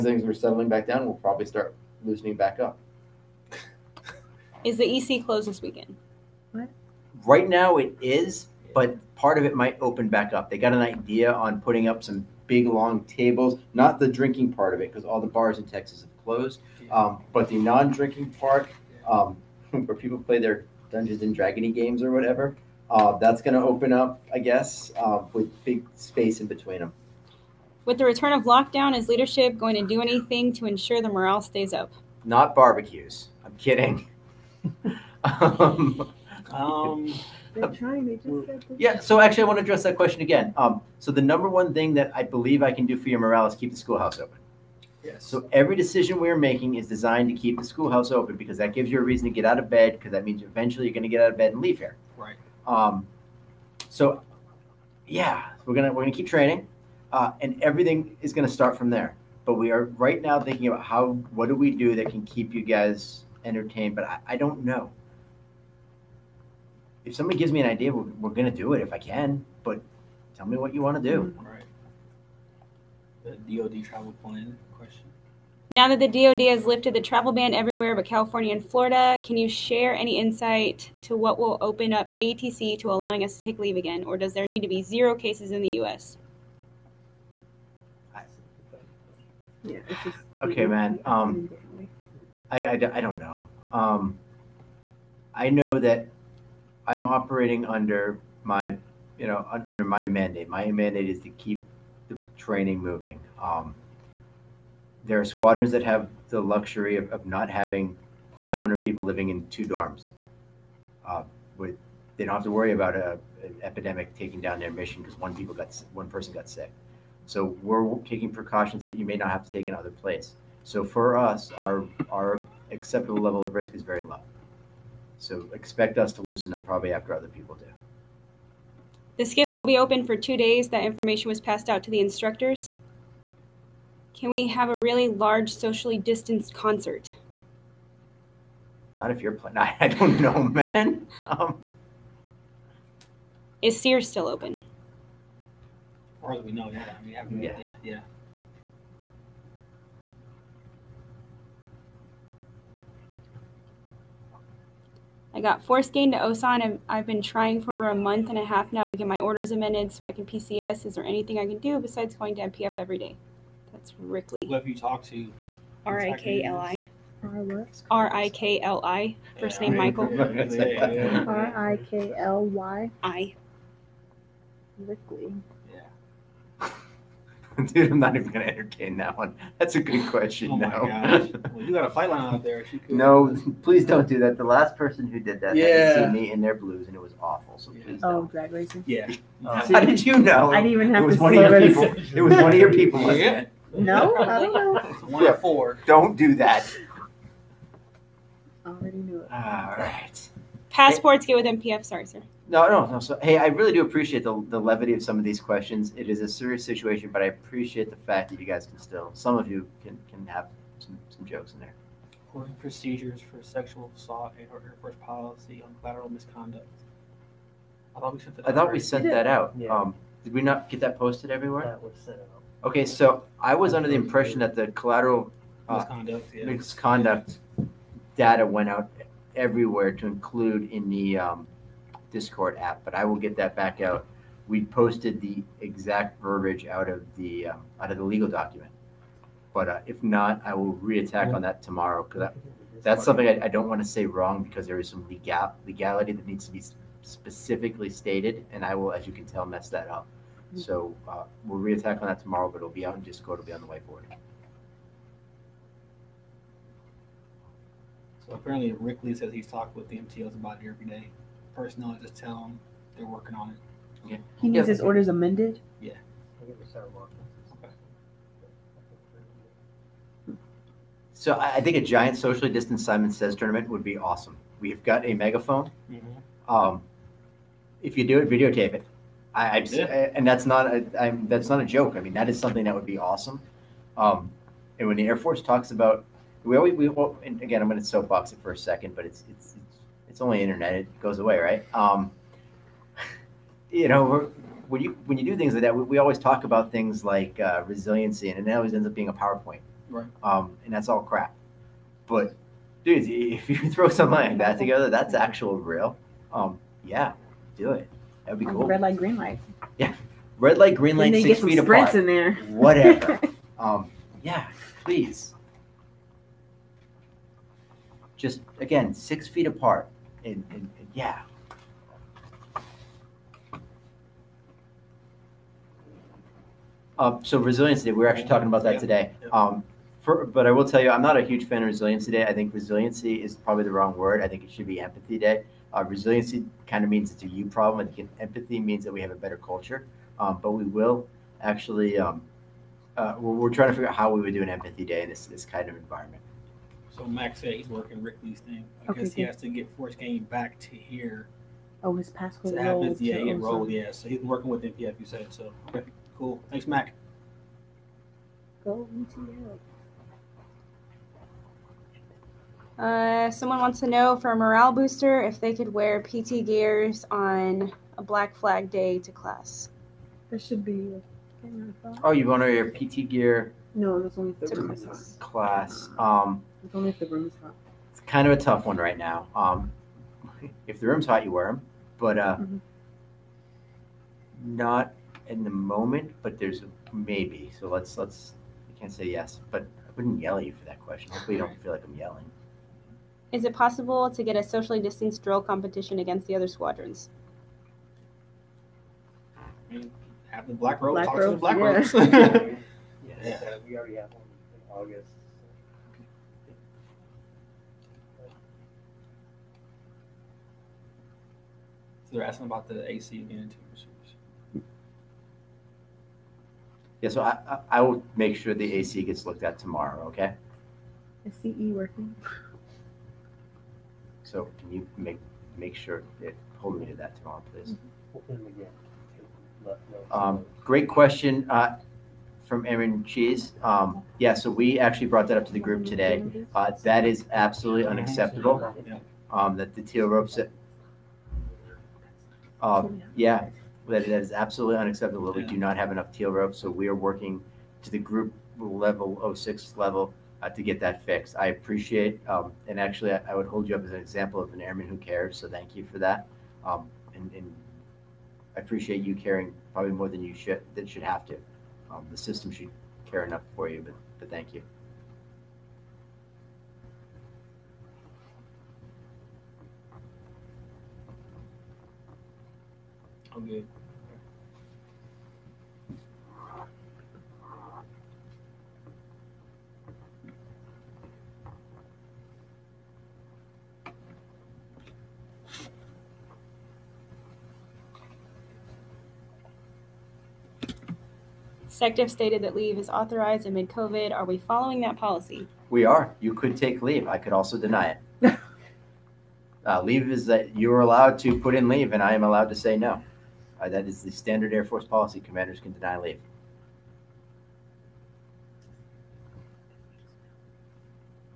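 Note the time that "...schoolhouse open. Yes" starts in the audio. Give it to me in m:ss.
0:43.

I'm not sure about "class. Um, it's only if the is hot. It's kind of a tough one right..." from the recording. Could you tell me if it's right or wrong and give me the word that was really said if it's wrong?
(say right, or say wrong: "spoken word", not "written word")
right.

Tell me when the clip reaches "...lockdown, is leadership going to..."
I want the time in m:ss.
0:28.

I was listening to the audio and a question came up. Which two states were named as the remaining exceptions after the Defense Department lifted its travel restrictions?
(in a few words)
California and Florida.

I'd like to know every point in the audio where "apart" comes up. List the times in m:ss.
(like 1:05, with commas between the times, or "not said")
5:11, 5:19.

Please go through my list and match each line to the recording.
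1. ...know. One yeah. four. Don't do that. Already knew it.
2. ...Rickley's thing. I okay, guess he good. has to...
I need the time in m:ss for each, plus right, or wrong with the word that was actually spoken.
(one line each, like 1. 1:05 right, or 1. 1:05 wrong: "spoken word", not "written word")
1. 3:14 right
2. 5:48 right.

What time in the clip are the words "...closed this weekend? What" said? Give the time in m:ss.
0:05.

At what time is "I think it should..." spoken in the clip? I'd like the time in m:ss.
5:34.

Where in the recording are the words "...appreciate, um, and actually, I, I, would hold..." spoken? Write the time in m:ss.
7:31.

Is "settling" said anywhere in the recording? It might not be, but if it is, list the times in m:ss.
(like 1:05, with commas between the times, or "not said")
0:00.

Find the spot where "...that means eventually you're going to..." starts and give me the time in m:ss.
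0:50.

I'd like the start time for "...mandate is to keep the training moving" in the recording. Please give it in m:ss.
1:40.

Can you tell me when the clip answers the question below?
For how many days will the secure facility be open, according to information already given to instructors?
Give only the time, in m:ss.
2:10.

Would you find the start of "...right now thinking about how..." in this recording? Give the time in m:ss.
0:59.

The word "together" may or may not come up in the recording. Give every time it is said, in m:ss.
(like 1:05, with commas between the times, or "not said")
5:04.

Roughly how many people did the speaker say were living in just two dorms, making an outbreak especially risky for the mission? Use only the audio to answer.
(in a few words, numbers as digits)
500.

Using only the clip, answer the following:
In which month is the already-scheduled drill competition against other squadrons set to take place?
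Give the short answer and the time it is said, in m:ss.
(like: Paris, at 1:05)
August, at 6:44.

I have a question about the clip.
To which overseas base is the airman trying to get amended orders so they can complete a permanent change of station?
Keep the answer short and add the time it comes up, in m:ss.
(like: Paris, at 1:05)
Osan, at 2:36.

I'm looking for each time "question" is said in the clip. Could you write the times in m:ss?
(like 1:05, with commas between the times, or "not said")
0:39, 1:14, 3:00, 3:25, 6:30, 7:10.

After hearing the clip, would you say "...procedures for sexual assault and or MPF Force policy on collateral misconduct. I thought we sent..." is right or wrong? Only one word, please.
wrong.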